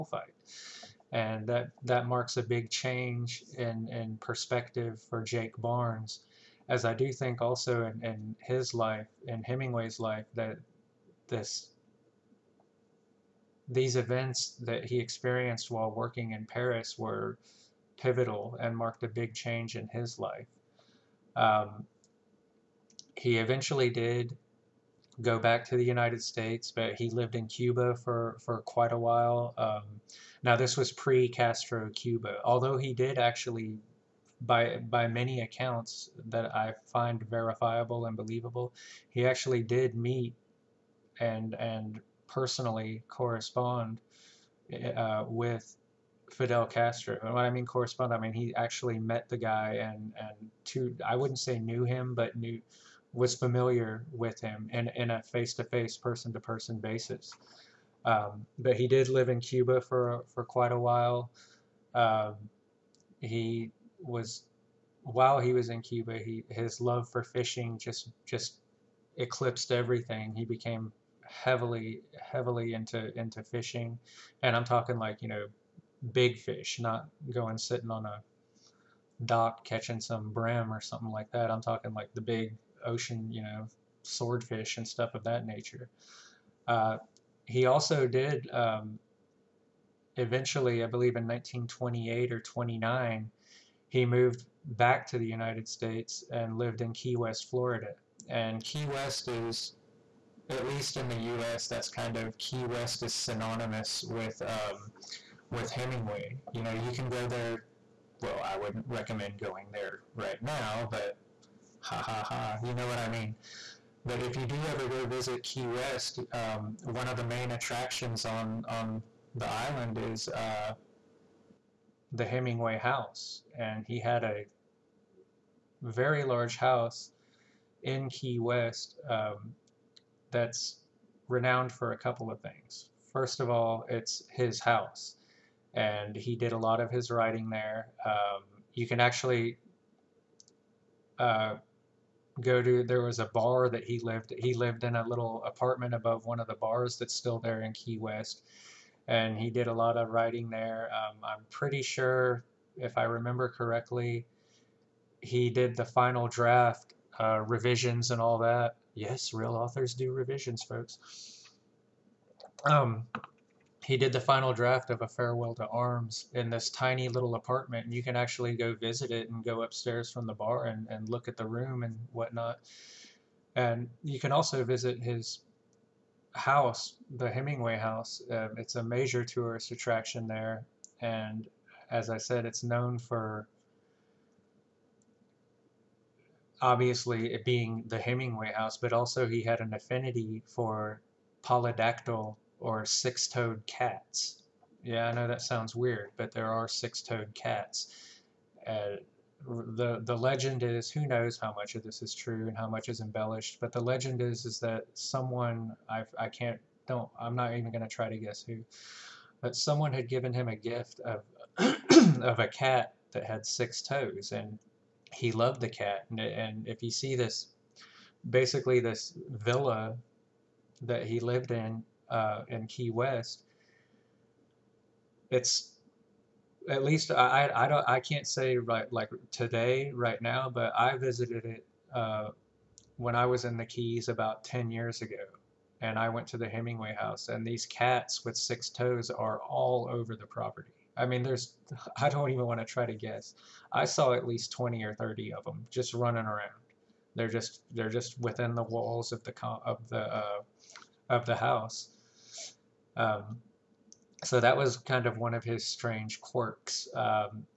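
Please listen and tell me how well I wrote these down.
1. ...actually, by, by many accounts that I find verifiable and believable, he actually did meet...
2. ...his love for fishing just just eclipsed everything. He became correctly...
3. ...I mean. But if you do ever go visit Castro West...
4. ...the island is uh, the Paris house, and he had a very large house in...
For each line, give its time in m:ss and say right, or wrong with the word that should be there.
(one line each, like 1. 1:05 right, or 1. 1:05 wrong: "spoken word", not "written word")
1. 0:33 right
2. 1:06 wrong: "heavily", not "correctly"
3. 1:52 wrong: "Key", not "Castro"
4. 1:59 wrong: "Hemingway", not "Paris".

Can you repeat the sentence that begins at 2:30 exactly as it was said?
Um, I'm pretty sure, if I remember correctly, he did the final draft uh, revisions and all that.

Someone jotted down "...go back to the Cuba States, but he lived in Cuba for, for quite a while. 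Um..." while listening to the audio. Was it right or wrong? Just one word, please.
wrong.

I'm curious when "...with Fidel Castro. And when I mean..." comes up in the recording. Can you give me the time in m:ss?
0:45.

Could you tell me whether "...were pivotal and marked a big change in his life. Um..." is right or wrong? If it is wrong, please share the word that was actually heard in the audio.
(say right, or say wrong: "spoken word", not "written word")
right.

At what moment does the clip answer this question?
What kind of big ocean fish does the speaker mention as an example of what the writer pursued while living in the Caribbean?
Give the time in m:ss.
1:24.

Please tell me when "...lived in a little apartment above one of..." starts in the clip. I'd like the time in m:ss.
2:24.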